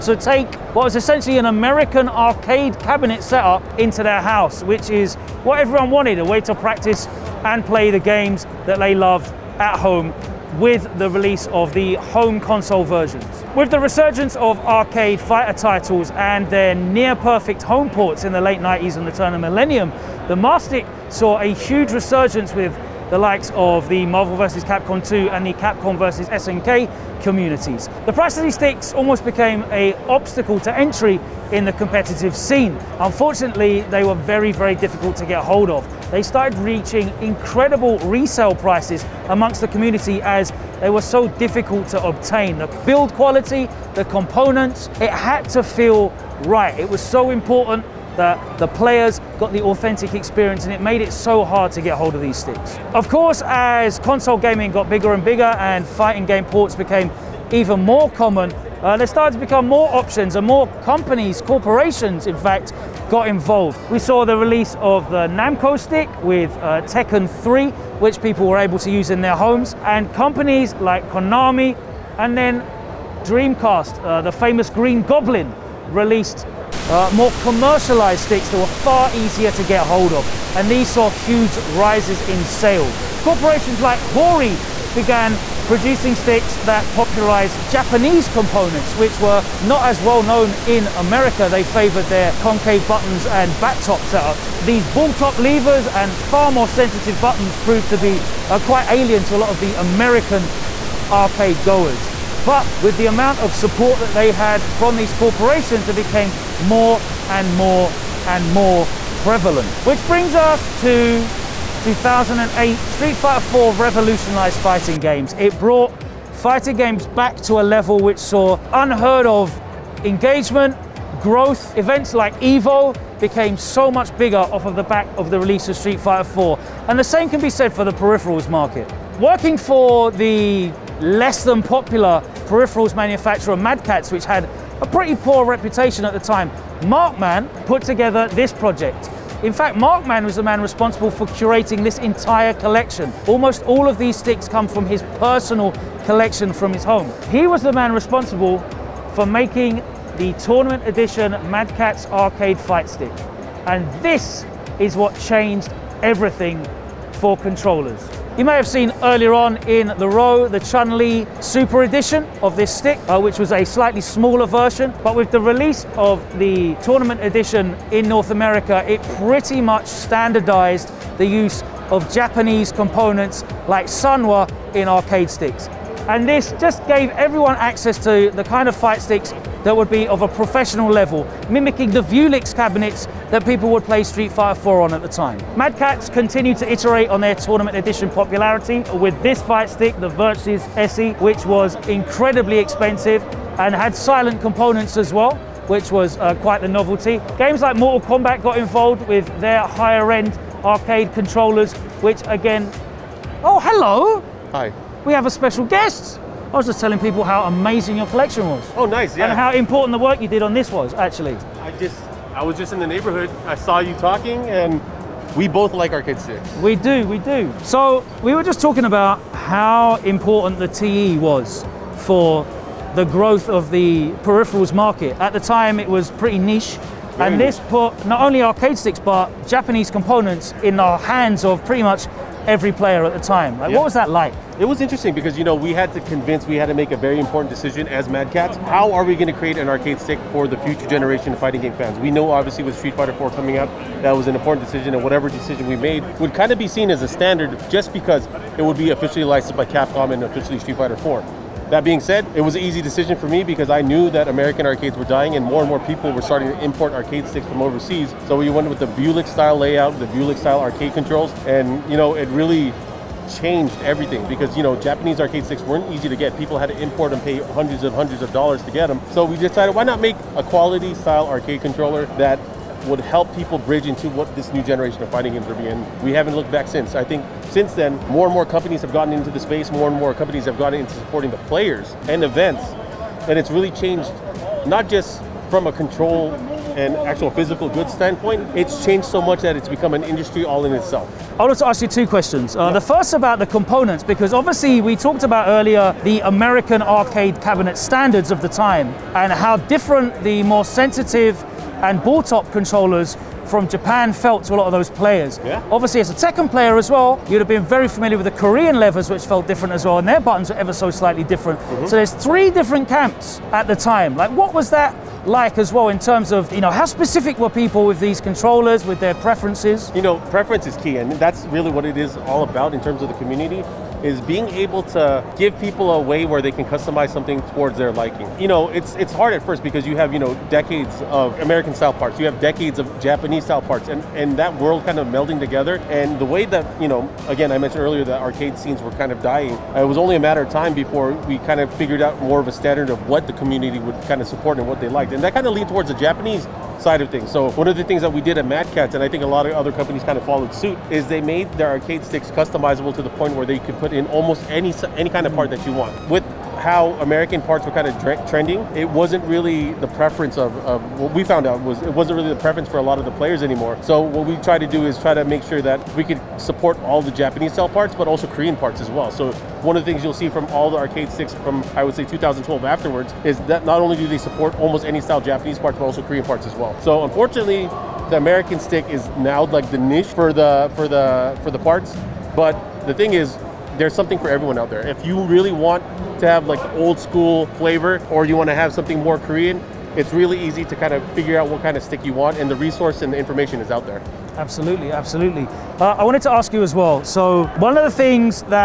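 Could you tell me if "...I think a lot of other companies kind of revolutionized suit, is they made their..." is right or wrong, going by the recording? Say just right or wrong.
wrong.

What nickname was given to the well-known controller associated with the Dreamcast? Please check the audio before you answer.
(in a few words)
Green Goblin.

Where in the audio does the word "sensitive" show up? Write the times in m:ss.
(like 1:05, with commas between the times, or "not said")
1:36, 5:00.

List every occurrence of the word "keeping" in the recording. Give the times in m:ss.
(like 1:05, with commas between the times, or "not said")
not said.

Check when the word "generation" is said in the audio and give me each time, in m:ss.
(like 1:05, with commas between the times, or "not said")
4:00, 4:34.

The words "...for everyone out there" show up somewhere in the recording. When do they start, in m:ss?
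6:24.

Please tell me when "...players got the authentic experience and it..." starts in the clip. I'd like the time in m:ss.
0:48.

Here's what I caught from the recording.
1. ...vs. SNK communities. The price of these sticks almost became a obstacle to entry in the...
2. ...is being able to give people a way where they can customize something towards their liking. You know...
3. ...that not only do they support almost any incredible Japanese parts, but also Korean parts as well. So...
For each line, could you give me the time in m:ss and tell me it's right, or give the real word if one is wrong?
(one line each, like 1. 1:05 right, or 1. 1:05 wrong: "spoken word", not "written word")
1. 0:25 right
2. 5:24 right
3. 6:13 wrong: "style", not "incredible".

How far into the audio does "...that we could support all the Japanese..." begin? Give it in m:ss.
6:05.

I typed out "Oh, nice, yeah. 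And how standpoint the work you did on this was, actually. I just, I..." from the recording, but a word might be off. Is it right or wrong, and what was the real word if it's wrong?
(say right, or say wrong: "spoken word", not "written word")
wrong: "important", not "standpoint".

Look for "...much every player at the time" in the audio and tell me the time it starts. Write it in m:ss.
3:51.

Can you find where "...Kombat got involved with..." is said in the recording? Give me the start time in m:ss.
3:18.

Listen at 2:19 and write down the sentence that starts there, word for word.
In fact, Markman was the man responsible for curating this entire collection.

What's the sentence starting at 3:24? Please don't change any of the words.
Hi we have a special guest.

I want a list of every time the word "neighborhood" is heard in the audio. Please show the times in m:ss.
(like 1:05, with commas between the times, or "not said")
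3:32.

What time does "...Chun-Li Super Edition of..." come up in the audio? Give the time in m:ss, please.
2:40.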